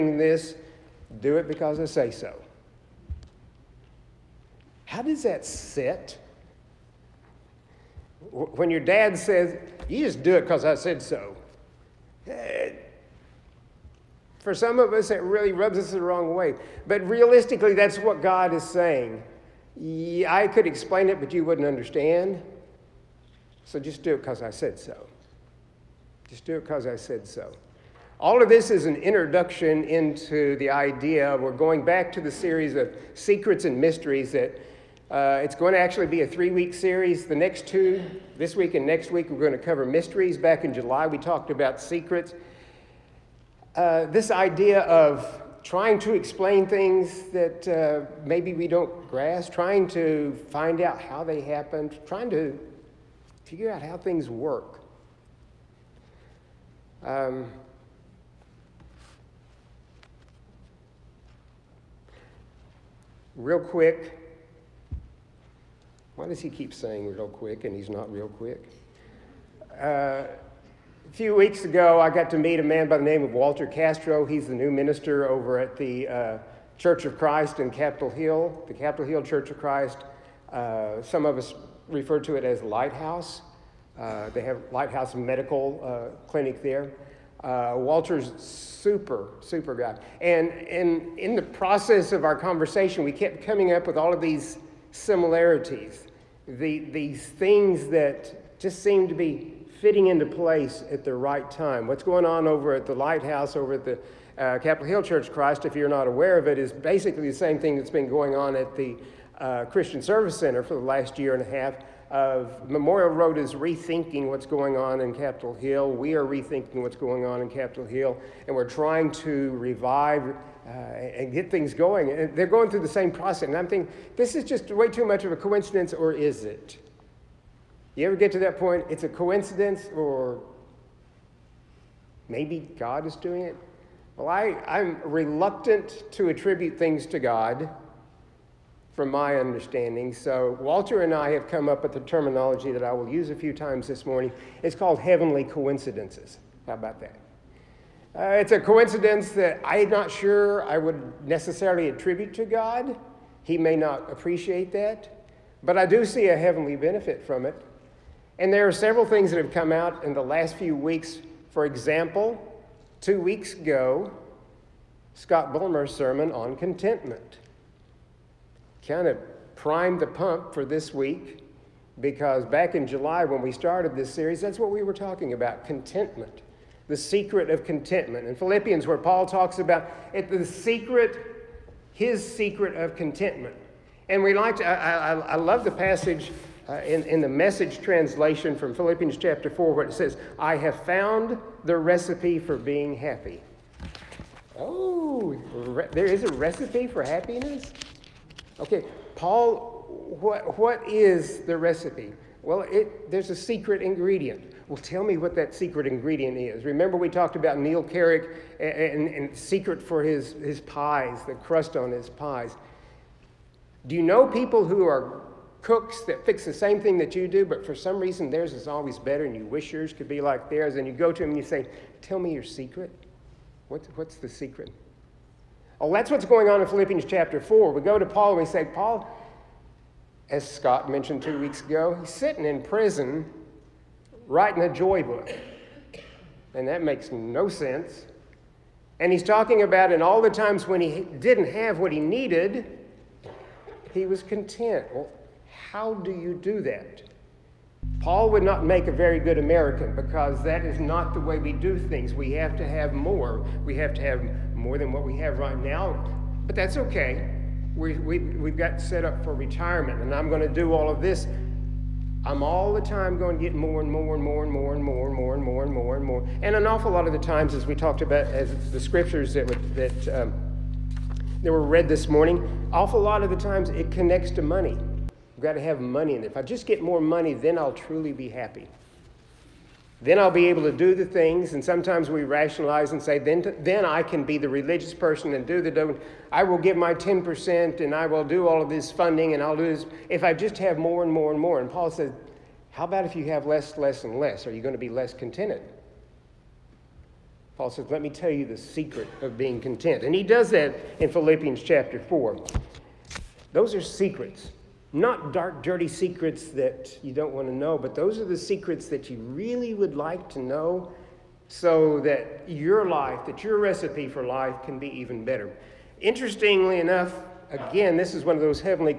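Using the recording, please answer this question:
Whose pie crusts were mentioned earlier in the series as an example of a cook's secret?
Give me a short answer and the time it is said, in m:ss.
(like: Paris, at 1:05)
Neil Carrick, at 3:27.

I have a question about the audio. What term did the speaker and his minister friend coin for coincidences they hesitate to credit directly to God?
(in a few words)
heavenly coincidences.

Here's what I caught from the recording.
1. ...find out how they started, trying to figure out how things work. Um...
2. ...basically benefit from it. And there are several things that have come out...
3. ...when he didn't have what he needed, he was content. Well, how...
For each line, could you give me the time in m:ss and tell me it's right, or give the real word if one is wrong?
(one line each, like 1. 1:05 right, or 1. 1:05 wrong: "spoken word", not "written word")
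1. 0:50 wrong: "happened", not "started"
2. 2:36 wrong: "heavenly", not "basically"
3. 4:00 right.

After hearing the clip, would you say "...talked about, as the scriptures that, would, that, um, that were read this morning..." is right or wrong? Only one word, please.
right.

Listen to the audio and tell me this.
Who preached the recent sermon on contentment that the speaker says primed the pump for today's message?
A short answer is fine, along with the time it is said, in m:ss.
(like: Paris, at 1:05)
Scott Bulmer, at 2:45.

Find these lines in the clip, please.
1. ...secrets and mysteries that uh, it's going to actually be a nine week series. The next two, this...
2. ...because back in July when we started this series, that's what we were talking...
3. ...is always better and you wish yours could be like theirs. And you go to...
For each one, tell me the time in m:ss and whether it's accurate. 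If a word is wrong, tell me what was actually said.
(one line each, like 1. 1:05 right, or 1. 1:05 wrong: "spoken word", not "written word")
1. 0:33 wrong: "three", not "nine"
2. 2:52 right
3. 3:38 right.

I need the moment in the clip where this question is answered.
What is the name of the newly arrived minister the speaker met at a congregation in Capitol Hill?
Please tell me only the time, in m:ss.
1:13.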